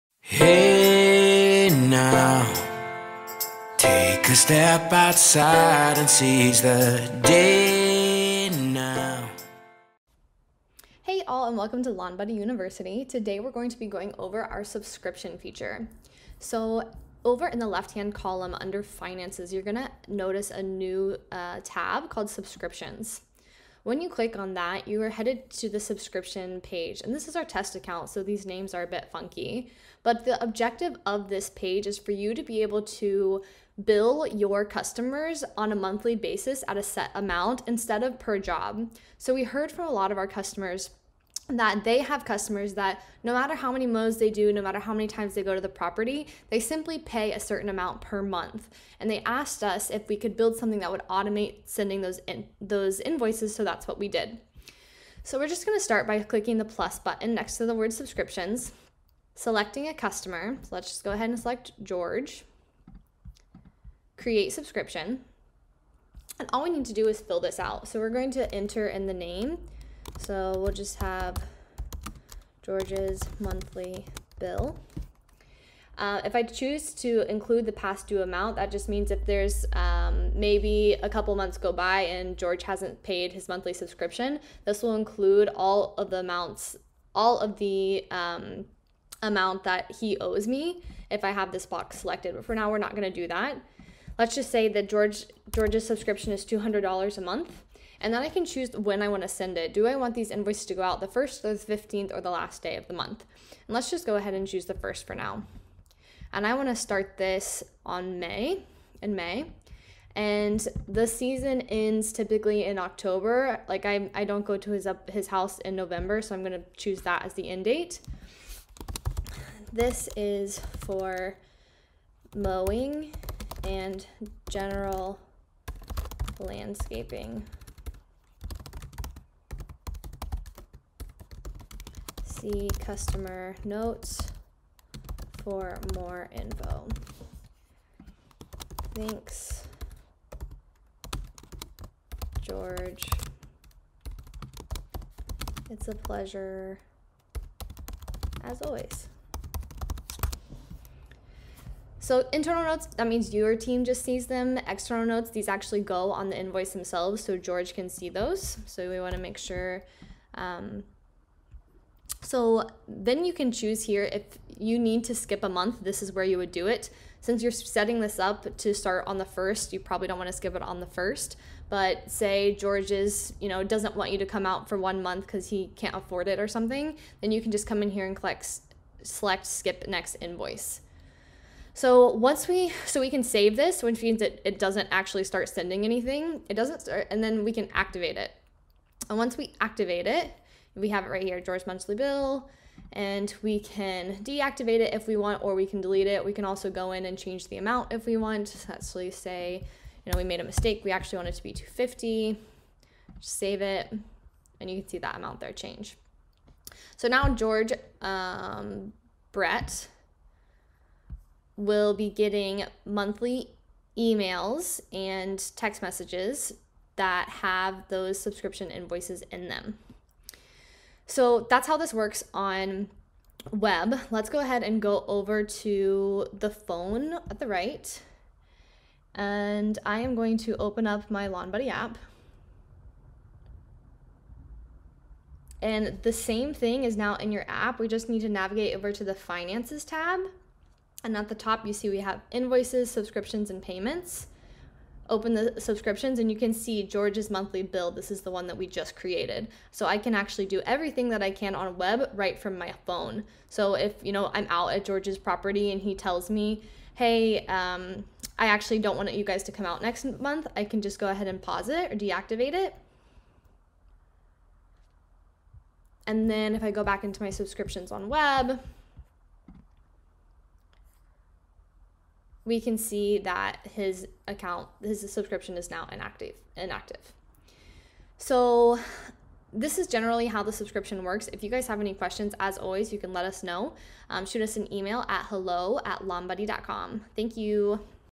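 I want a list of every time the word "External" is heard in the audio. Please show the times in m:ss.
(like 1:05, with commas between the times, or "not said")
2:34.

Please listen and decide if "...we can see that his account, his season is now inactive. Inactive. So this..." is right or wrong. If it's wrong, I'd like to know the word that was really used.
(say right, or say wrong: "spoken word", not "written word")
wrong: "subscription", not "season".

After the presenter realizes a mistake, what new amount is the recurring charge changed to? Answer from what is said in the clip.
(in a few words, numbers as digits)
250.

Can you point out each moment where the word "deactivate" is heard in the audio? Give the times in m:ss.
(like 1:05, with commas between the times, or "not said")
3:14, 4:21.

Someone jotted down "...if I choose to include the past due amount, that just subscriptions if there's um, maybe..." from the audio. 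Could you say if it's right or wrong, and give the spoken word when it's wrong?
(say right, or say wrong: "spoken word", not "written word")
wrong: "means", not "subscriptions".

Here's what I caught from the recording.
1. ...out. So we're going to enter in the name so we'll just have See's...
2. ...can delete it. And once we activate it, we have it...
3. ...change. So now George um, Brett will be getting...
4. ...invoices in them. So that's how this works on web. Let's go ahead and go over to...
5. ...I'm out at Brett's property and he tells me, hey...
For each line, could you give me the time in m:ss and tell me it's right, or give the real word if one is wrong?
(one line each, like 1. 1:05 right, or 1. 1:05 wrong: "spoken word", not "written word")
1. 1:07 wrong: "George", not "See"
2. 3:07 wrong: "activate", not "delete"
3. 3:25 right
4. 3:38 right
5. 4:14 wrong: "George", not "Brett".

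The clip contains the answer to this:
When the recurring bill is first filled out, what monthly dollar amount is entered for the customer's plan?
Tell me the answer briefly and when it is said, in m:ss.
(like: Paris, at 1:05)
$200, at 1:36.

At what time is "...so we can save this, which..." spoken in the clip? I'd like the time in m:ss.
3:02.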